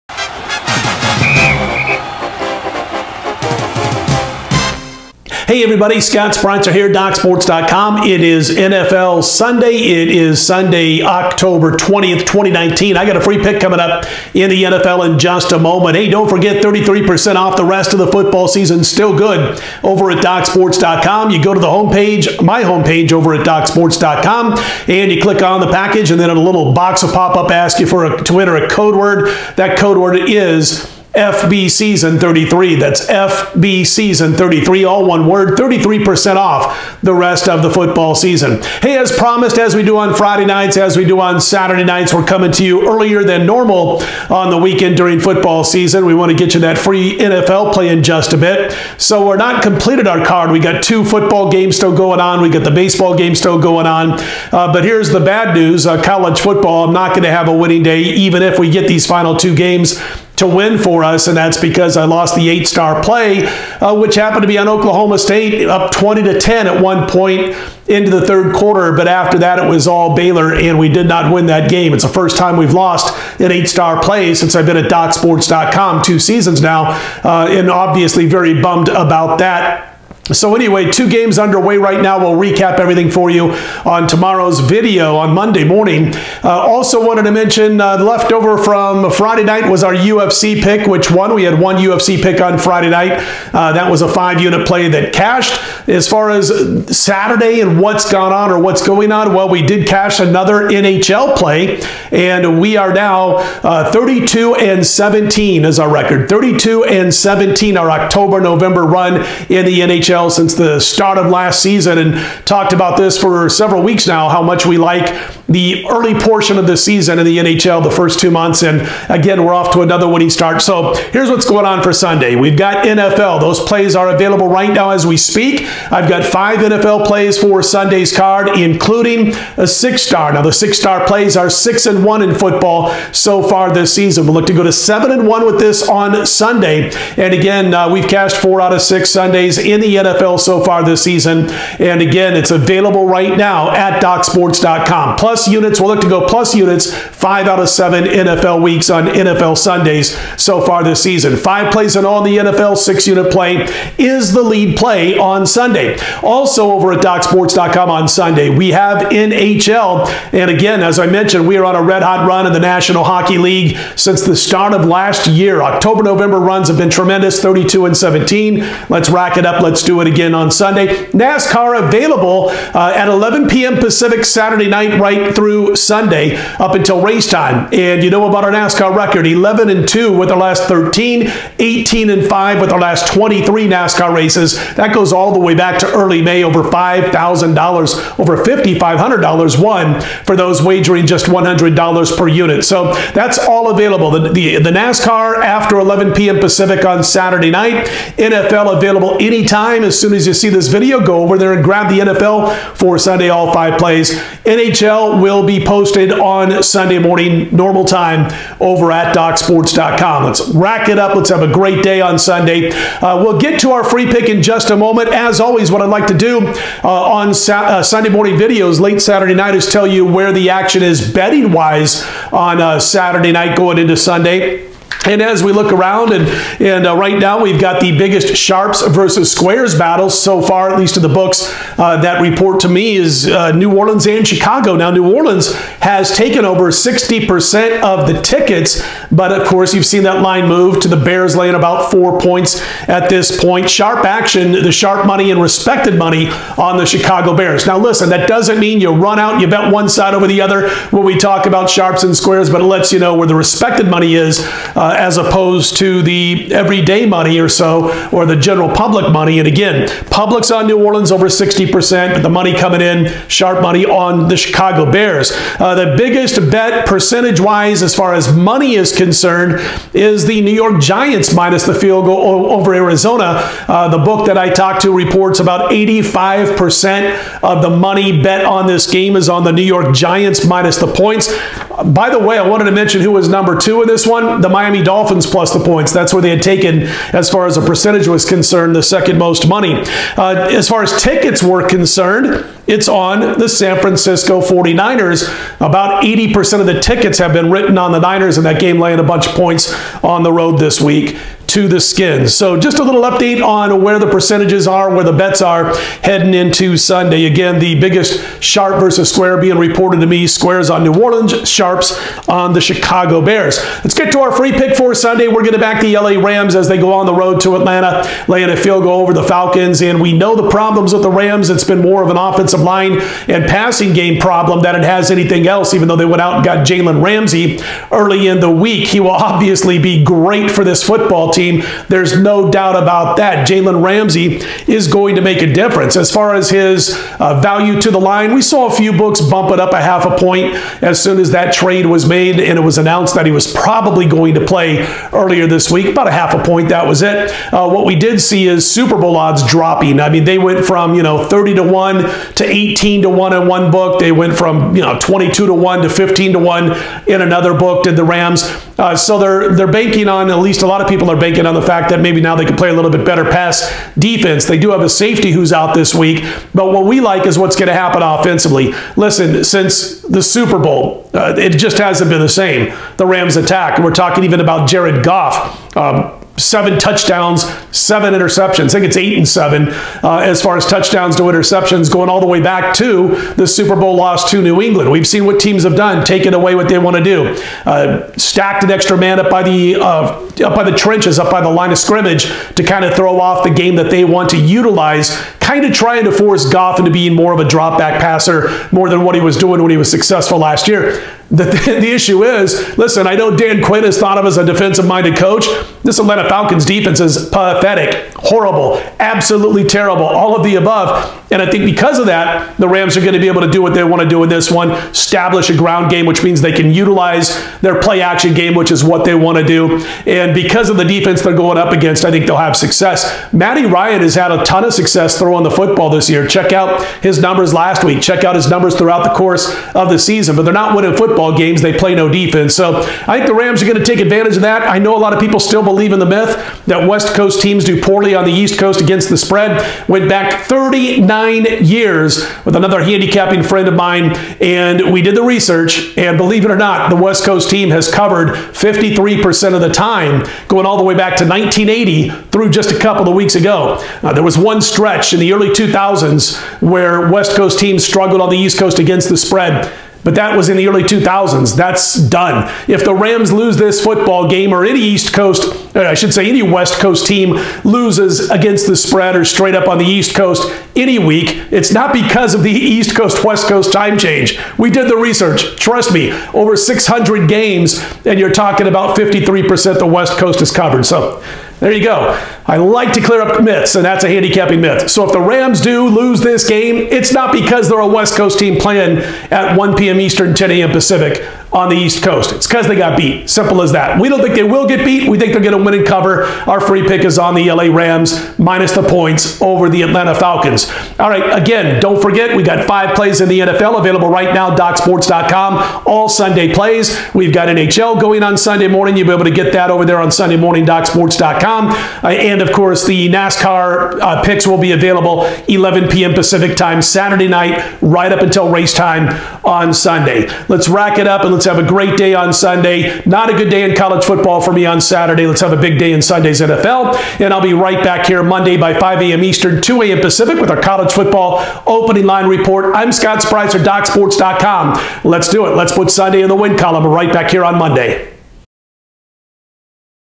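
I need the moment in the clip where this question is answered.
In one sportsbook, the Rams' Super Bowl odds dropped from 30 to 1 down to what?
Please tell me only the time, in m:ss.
5:52.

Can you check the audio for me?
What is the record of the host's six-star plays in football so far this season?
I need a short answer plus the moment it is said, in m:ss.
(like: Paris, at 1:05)
6 and 1, at 2:11.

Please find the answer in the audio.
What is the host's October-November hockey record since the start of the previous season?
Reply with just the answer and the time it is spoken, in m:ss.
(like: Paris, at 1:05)
32 and 17, at 1:43.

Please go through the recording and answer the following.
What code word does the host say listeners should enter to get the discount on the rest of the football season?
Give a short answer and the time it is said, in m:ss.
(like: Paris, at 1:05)
FB Season 33, at 0:33.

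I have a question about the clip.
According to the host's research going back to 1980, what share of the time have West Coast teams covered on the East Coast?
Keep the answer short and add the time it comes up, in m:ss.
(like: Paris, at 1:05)
53%, at 7:28.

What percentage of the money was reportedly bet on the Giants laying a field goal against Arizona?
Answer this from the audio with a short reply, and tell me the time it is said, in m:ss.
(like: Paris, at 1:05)
85%, at 4:35.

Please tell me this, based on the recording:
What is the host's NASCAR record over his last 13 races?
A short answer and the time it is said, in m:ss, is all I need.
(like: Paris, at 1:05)
11 and 2, at 2:59.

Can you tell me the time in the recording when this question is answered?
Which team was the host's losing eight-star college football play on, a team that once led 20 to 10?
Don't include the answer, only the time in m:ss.
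1:04.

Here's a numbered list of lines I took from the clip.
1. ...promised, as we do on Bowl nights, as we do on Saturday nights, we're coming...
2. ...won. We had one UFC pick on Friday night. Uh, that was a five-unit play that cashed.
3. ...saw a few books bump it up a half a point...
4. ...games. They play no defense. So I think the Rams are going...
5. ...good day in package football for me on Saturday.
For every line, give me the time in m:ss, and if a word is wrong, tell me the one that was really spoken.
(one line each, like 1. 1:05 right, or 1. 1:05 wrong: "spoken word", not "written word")
1. 0:39 wrong: "Friday", not "Bowl"
2. 1:31 right
3. 5:38 right
4. 7:11 right
5. 8:43 wrong: "college", not "package".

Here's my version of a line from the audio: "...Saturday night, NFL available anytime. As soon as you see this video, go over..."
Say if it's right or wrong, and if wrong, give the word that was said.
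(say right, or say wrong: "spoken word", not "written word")
right.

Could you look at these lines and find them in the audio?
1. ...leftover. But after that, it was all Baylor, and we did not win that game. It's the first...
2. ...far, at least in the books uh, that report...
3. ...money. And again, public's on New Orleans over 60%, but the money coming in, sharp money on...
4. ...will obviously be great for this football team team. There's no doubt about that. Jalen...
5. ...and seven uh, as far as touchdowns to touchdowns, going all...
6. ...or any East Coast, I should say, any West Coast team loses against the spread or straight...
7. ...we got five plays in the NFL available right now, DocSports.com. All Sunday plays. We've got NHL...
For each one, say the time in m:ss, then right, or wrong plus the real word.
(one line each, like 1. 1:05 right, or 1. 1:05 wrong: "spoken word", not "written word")
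1. 1:08 wrong: "quarter", not "leftover"
2. 3:50 right
3. 4:19 right
4. 5:29 right
5. 6:19 wrong: "interceptions", not "touchdowns"
6. 7:44 right
7. 8:22 right.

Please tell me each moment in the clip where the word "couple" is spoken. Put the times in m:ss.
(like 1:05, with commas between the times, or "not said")
7:32.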